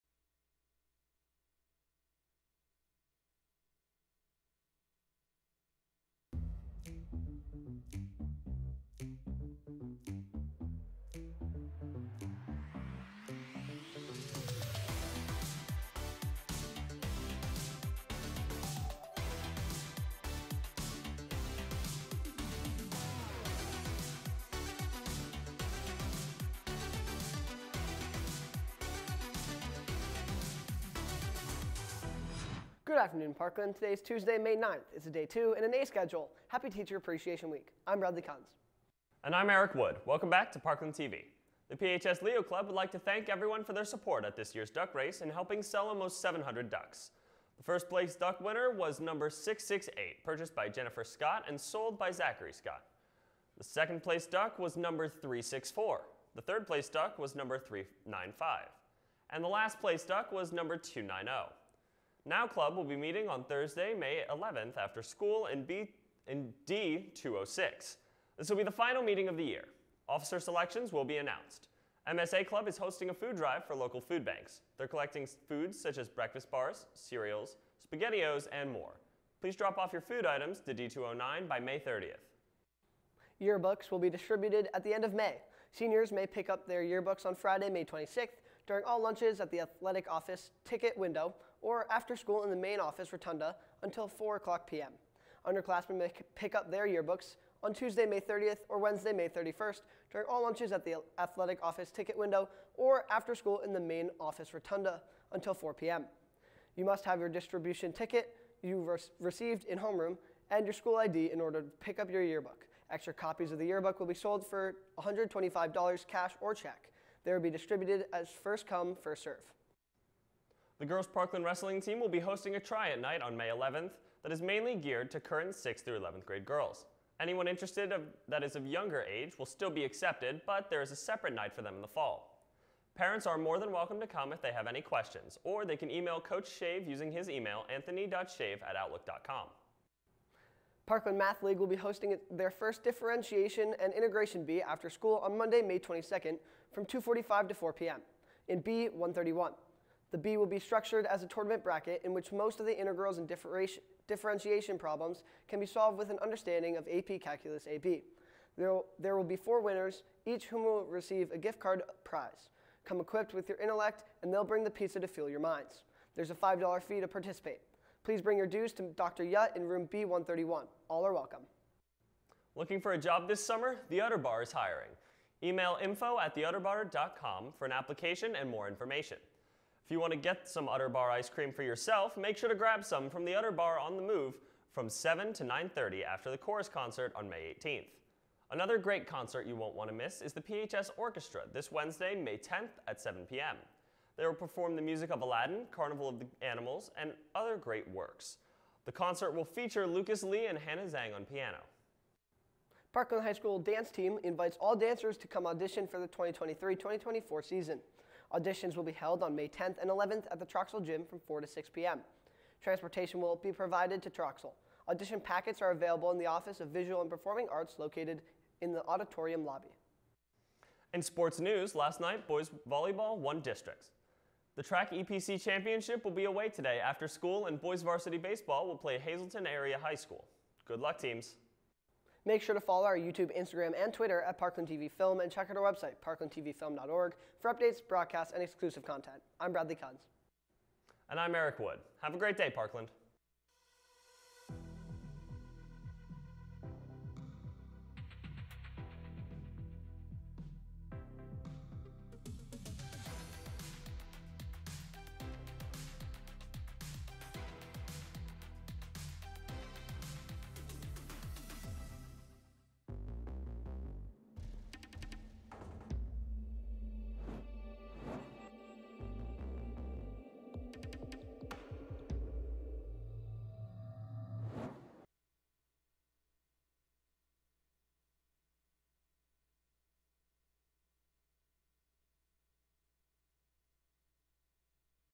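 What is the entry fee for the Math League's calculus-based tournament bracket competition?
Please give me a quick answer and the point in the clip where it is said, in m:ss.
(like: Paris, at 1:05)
$5, at 2:46.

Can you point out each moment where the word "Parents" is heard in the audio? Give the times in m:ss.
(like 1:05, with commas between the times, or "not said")
2:12.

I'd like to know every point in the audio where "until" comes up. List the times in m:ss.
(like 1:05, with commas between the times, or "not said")
1:33, 1:45.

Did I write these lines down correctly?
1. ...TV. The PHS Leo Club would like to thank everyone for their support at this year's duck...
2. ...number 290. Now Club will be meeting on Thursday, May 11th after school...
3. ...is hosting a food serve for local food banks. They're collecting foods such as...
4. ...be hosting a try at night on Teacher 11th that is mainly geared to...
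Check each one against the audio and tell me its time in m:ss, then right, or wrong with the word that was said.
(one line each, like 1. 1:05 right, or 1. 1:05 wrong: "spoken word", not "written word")
1. 0:40 right
2. 1:00 right
3. 1:12 wrong: "drive", not "serve"
4. 2:02 wrong: "May", not "Teacher".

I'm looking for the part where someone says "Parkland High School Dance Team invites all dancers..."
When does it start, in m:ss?
3:22.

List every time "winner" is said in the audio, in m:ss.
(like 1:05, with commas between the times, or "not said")
0:48, 2:39.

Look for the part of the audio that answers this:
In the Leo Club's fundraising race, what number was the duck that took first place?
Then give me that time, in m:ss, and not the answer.
0:48.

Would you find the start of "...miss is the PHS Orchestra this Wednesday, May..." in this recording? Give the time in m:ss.
3:09.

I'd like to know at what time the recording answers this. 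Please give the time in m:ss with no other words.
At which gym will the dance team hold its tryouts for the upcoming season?
3:30.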